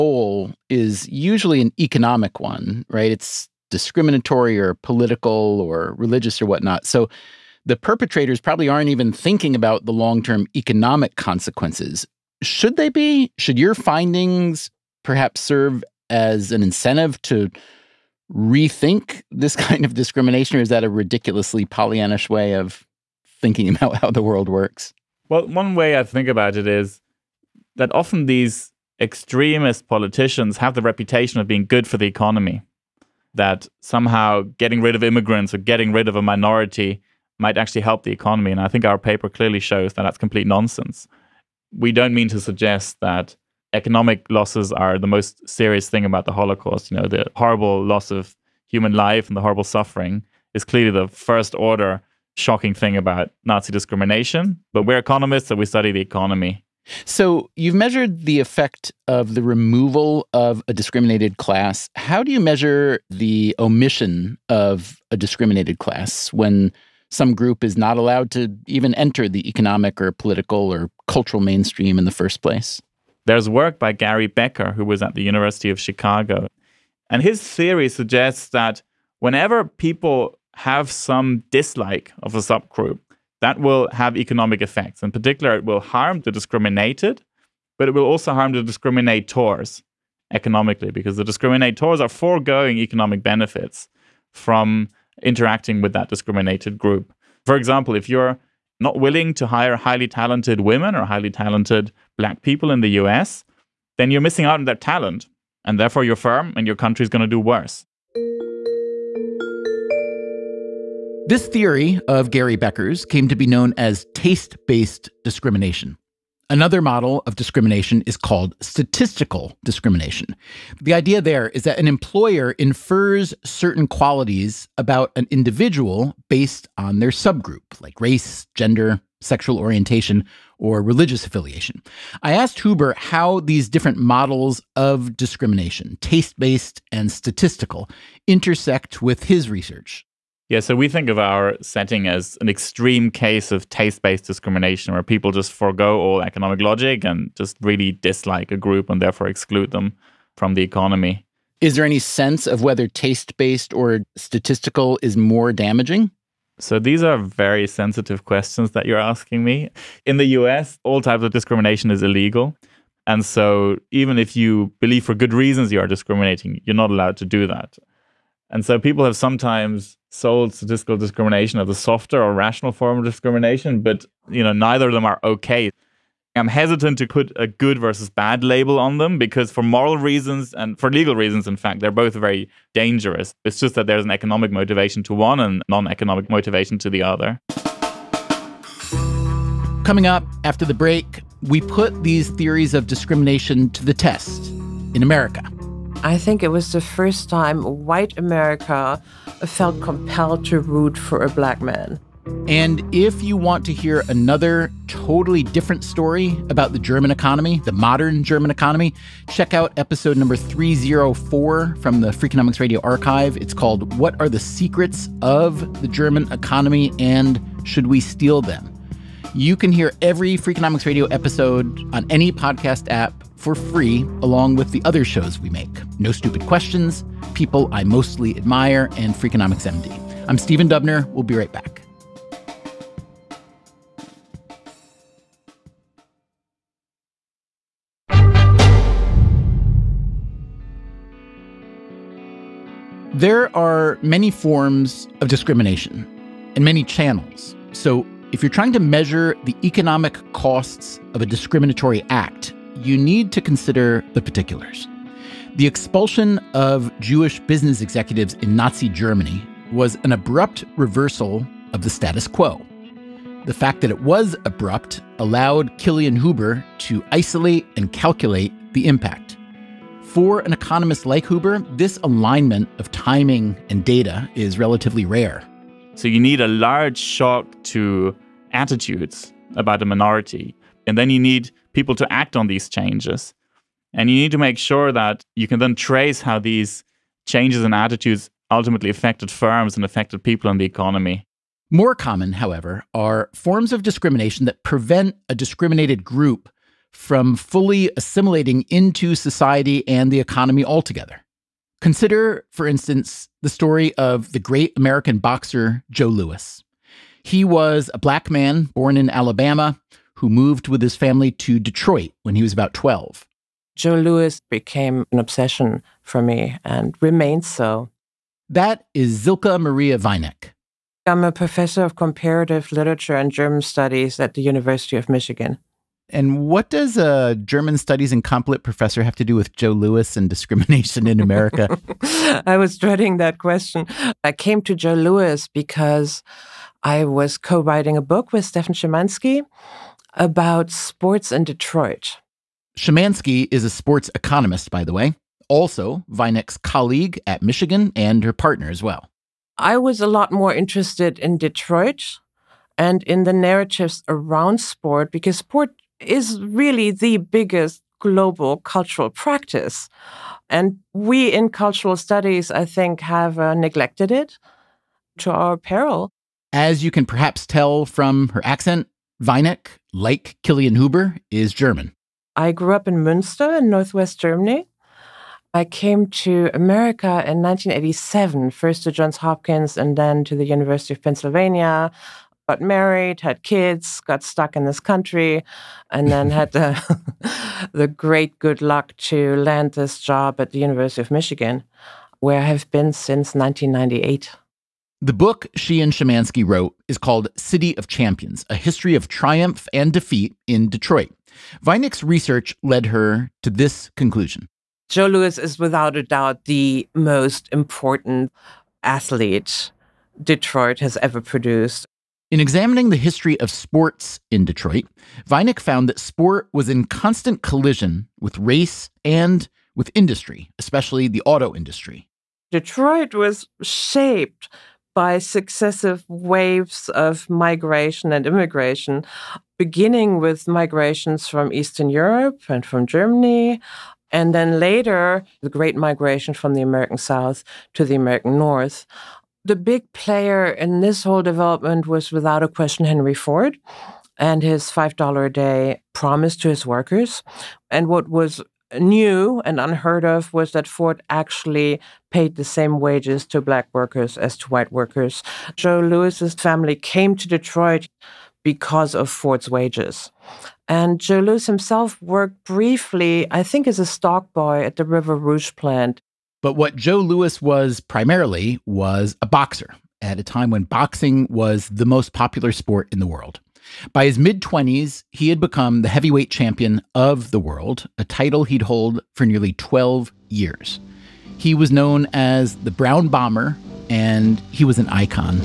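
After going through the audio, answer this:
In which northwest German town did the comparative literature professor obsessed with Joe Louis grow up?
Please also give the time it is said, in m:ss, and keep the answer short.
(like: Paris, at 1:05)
Münster, at 6:13.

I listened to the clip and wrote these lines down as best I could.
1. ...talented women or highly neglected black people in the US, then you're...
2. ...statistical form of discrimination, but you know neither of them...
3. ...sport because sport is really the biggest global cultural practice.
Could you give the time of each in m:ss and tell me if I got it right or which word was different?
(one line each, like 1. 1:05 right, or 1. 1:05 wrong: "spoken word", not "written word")
1. 1:40 wrong: "talented", not "neglected"
2. 2:52 wrong: "rational", not "statistical"
3. 5:54 right.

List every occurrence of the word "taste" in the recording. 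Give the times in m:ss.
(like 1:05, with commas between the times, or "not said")
1:54, 2:15, 2:23, 2:32.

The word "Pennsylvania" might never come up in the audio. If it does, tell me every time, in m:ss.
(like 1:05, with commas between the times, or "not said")
6:21.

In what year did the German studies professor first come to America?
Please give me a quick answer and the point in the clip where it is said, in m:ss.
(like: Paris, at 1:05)
1987, at 6:17.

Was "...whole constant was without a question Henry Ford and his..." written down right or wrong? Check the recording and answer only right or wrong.
wrong.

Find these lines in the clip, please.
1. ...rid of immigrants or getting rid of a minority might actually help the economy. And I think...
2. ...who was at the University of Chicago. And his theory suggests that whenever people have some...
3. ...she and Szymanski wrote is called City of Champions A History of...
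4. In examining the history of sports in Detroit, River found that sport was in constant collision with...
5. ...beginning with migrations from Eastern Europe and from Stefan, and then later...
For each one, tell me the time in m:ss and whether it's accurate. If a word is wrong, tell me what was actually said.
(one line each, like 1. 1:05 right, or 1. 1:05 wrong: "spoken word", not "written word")
1. 0:34 right
2. 1:14 right
3. 6:35 right
4. 6:52 wrong: "Vinick", not "River"
5. 7:09 wrong: "Germany", not "Stefan".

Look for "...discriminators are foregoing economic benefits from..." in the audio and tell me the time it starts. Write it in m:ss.
1:31.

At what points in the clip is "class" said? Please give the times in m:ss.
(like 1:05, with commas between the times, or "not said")
1:01, 1:05.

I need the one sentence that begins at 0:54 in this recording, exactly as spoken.
But we're economists, so we study the economy.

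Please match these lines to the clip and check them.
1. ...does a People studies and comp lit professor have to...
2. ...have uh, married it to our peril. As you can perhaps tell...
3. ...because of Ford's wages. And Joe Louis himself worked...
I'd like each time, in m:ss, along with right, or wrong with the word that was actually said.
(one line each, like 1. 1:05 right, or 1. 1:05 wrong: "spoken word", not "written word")
1. 5:26 wrong: "German", not "People"
2. 6:02 wrong: "neglected", not "married"
3. 7:38 right.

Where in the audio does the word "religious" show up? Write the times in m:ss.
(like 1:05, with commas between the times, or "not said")
0:05, 2:10.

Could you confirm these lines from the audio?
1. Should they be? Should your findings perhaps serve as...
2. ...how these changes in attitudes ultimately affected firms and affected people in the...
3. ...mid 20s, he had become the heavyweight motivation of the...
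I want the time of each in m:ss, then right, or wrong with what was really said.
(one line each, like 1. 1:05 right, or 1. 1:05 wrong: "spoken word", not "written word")
1. 0:12 right
2. 4:46 right
3. 7:54 wrong: "champion", not "motivation".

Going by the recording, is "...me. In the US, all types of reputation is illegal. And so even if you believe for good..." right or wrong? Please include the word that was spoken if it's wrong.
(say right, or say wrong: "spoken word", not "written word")
wrong: "discrimination", not "reputation".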